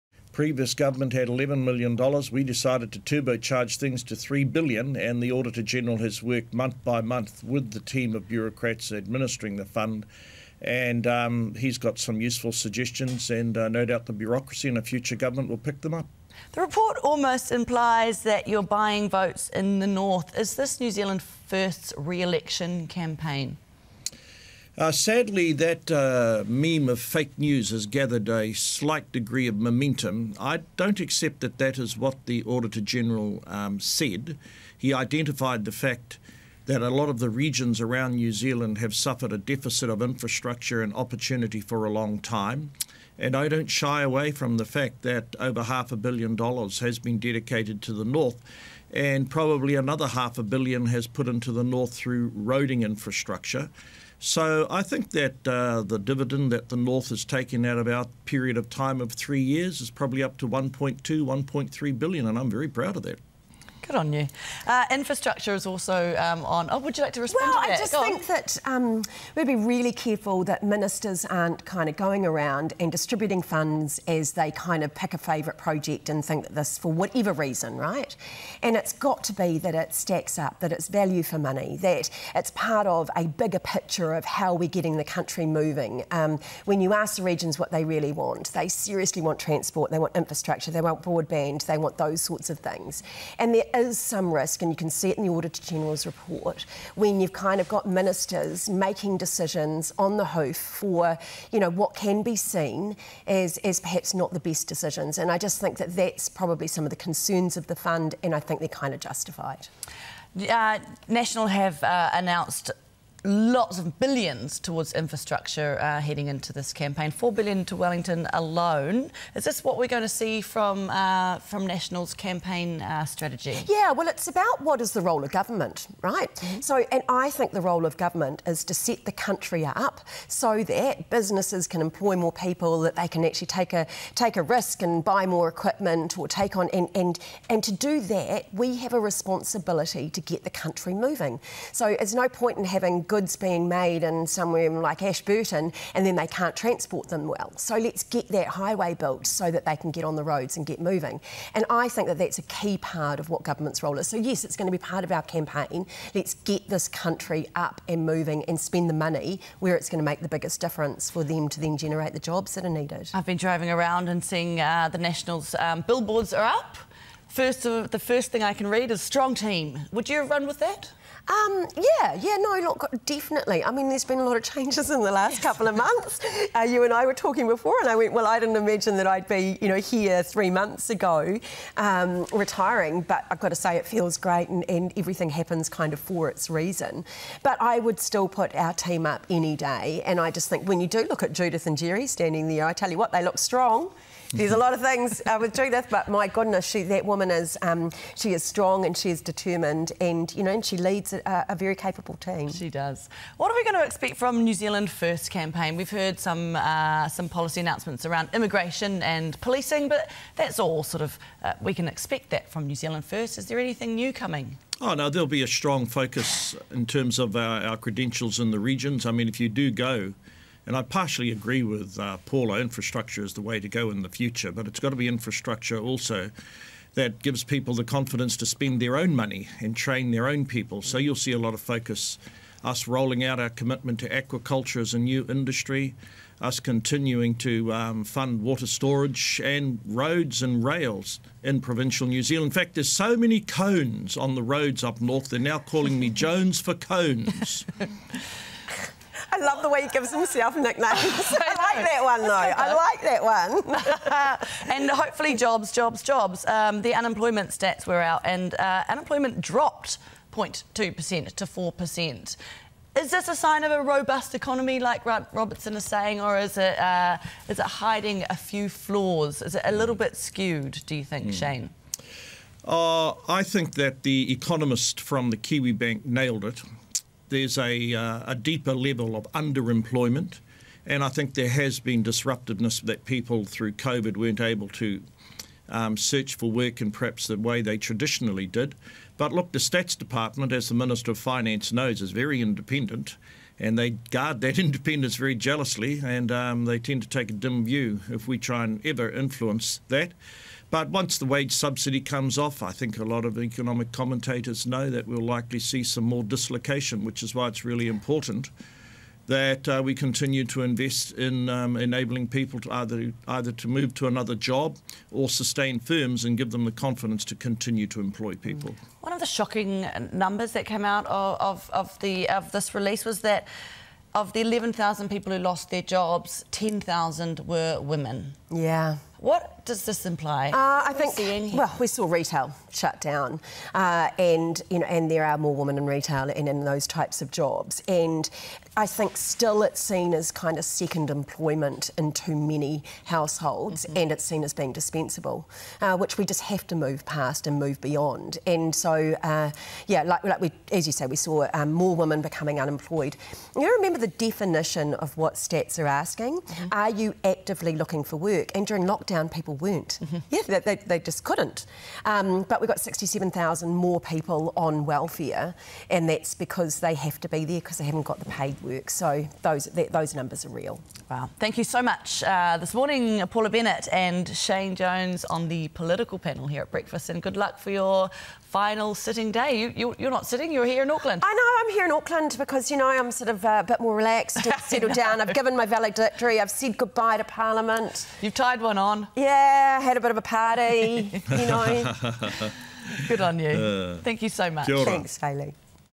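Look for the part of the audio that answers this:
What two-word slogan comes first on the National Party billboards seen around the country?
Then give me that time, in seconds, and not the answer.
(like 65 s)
169 s.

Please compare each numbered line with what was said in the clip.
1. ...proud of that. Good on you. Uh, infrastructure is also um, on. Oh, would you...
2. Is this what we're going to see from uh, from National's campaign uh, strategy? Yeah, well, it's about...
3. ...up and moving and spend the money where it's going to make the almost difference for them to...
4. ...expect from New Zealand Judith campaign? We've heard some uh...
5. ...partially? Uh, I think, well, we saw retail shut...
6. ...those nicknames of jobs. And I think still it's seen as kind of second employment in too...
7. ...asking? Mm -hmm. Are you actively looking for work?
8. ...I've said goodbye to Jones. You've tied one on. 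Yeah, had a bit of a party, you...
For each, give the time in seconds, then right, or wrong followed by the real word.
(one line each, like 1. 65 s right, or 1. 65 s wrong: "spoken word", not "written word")
1. 62 s right
2. 119 s right
3. 157 s wrong: "biggest", not "almost"
4. 203 s wrong: "First", not "Judith"
5. 330 s wrong: "imply", not "partially"
6. 336 s wrong: "types", not "nicknames"
7. 355 s right
8. 386 s wrong: "Parliament", not "Jones".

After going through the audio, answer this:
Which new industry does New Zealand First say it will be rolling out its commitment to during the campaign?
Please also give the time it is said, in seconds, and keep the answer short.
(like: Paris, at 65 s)
aquaculture, at 234 s.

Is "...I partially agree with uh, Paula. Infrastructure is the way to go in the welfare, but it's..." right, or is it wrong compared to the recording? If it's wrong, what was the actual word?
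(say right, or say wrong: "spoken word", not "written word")
wrong: "future", not "welfare".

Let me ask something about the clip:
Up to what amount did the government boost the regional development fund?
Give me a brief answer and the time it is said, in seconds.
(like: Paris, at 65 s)
$3 billion, at 4 s.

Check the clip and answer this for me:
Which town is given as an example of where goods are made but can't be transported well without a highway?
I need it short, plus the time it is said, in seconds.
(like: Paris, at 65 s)
Ashburton, at 145 s.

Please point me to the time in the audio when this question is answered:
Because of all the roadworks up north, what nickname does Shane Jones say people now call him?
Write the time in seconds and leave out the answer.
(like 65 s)
246 s.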